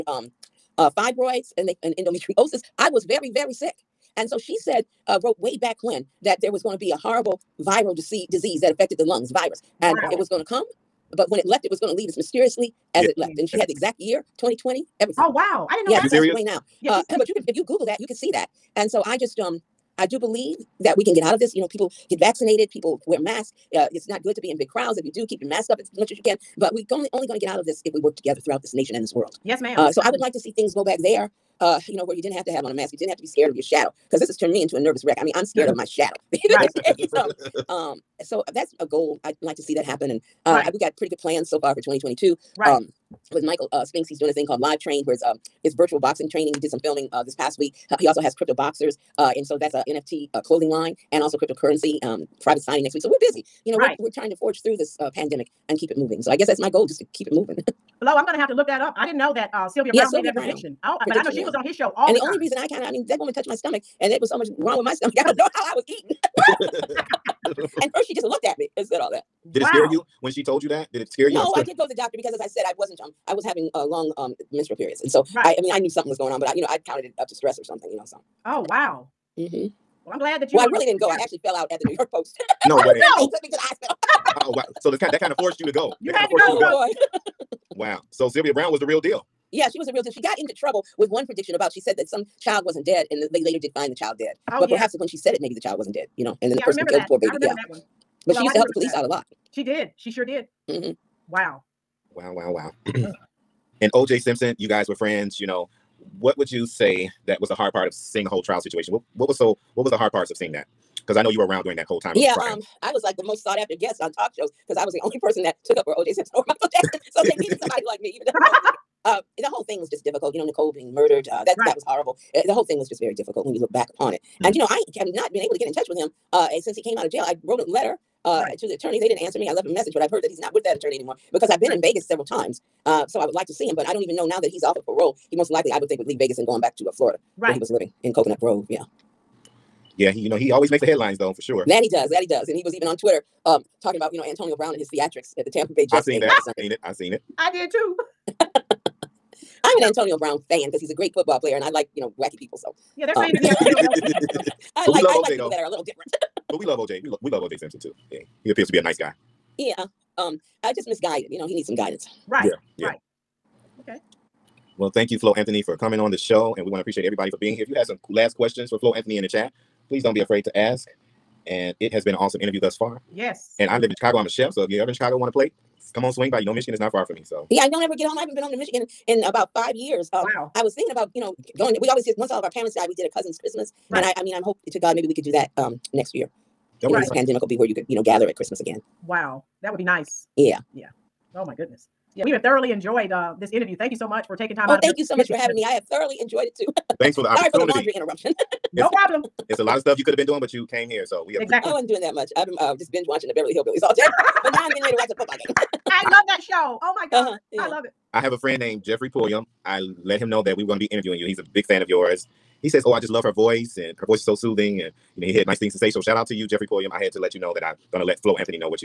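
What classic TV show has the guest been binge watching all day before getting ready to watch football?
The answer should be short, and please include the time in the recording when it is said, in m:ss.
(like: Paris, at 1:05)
The Beverly Hillbillies, at 3:23.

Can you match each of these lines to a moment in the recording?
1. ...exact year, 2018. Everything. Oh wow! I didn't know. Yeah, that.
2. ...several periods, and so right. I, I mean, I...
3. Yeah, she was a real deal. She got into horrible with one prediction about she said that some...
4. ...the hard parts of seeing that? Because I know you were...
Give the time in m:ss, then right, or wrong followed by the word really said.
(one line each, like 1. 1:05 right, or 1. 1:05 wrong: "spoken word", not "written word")
1. 0:13 wrong: "2020", not "2018"
2. 1:14 wrong: "menstrual", not "several"
3. 1:29 wrong: "trouble", not "horrible"
4. 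1:49 right.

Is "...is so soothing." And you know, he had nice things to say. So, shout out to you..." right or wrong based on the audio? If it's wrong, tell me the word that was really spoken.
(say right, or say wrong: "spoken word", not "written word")
right.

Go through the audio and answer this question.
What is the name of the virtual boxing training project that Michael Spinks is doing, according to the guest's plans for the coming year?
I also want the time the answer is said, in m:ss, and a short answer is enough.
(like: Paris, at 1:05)
Live Train, at 0:44.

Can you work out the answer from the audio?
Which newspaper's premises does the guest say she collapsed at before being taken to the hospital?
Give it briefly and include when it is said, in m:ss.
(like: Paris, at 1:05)
New York Post, at 1:21.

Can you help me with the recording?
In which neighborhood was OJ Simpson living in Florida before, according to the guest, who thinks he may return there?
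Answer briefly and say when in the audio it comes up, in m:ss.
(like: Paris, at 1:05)
Coconut Grove, at 2:18.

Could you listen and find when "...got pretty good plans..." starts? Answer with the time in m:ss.
0:40.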